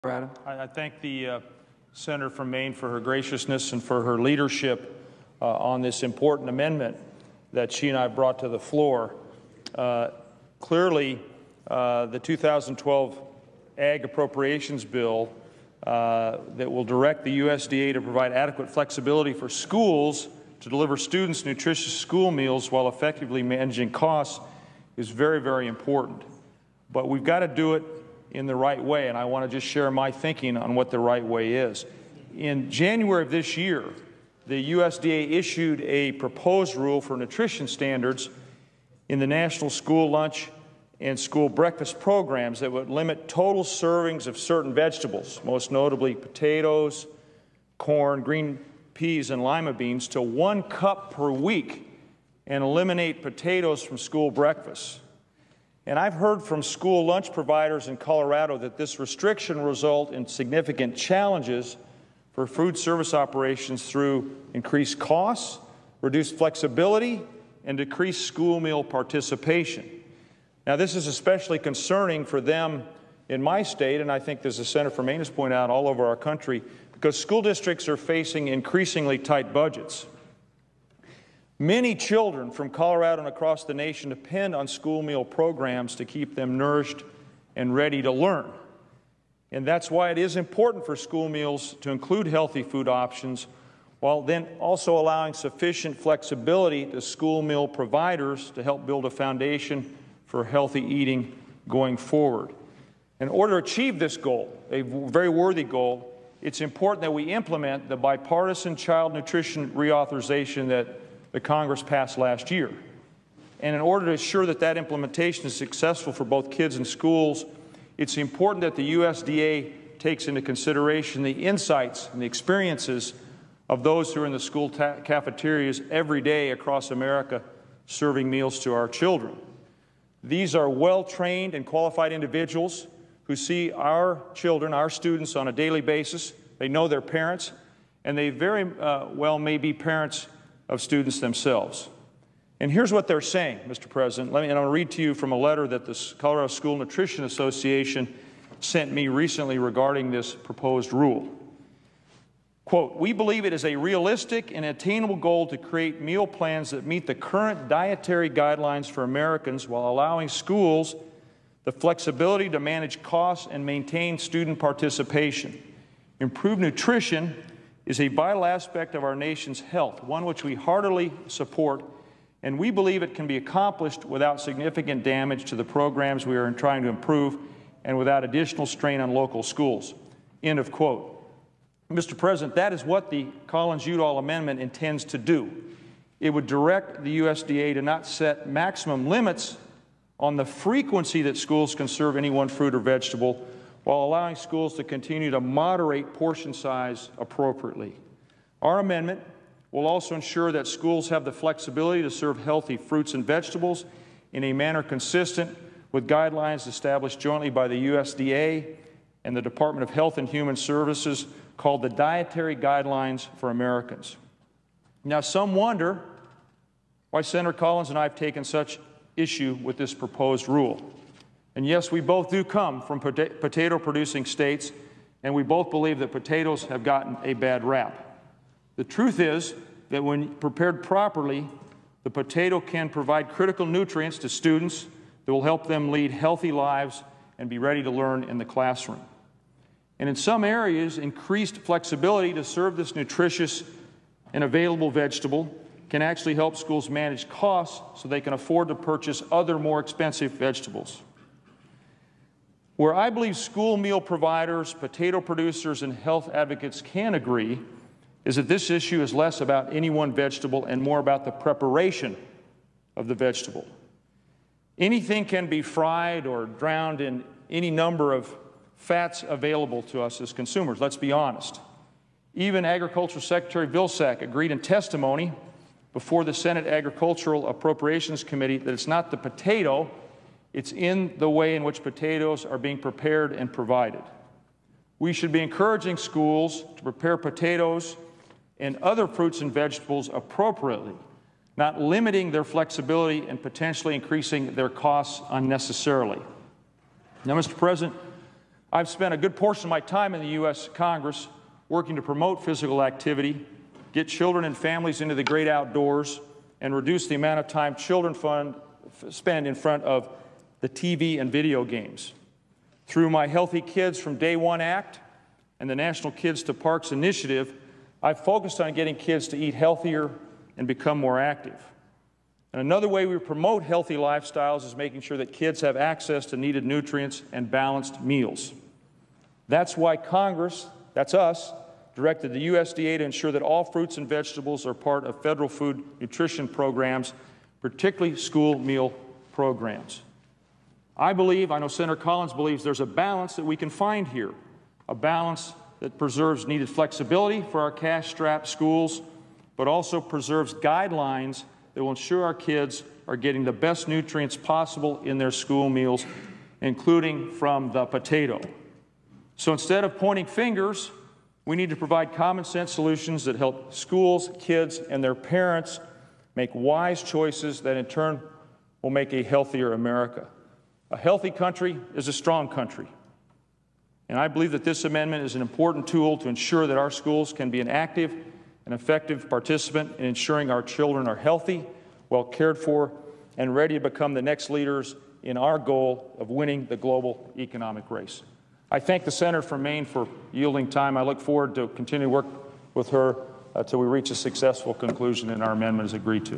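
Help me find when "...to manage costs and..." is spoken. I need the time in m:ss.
2:42.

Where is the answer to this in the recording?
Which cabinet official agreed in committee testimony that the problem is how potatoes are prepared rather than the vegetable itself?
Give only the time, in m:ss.
4:33.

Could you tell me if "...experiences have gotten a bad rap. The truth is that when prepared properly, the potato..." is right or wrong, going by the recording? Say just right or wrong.
wrong.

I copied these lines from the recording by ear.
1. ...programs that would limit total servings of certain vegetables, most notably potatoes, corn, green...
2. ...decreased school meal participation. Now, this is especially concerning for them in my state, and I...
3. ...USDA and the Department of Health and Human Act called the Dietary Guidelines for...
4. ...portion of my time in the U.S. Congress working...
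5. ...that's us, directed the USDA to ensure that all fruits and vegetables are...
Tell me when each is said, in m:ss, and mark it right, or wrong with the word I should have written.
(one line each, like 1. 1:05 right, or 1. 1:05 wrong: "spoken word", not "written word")
1. 0:41 right
2. 1:07 right
3. 3:27 wrong: "Services", not "Act"
4. 4:59 right
5. 5:30 right.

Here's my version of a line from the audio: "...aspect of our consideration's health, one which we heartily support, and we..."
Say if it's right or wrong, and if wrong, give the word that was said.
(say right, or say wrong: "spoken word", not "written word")
wrong: "nation", not "consideration".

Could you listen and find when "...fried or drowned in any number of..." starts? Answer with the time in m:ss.
4:25.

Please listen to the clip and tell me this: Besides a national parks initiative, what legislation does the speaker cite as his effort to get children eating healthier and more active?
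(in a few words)
Healthy Kids from Day One Act.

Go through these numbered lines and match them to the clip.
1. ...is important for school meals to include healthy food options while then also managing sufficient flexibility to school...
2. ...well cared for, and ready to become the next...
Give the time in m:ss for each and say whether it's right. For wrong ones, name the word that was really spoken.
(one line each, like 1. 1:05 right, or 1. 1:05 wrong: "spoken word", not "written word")
1. 1:30 wrong: "allowing", not "managing"
2. 6:22 right.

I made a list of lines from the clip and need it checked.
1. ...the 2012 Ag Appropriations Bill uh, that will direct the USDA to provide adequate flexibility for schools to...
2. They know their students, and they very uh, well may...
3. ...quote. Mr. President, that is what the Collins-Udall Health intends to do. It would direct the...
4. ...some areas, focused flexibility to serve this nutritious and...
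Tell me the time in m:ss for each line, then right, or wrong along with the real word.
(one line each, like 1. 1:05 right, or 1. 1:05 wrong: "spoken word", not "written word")
1. 0:12 right
2. 2:16 wrong: "parents", not "students"
3. 3:00 wrong: "Amendment", not "Health"
4. 4:00 wrong: "increased", not "focused".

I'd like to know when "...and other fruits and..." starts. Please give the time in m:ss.
4:48.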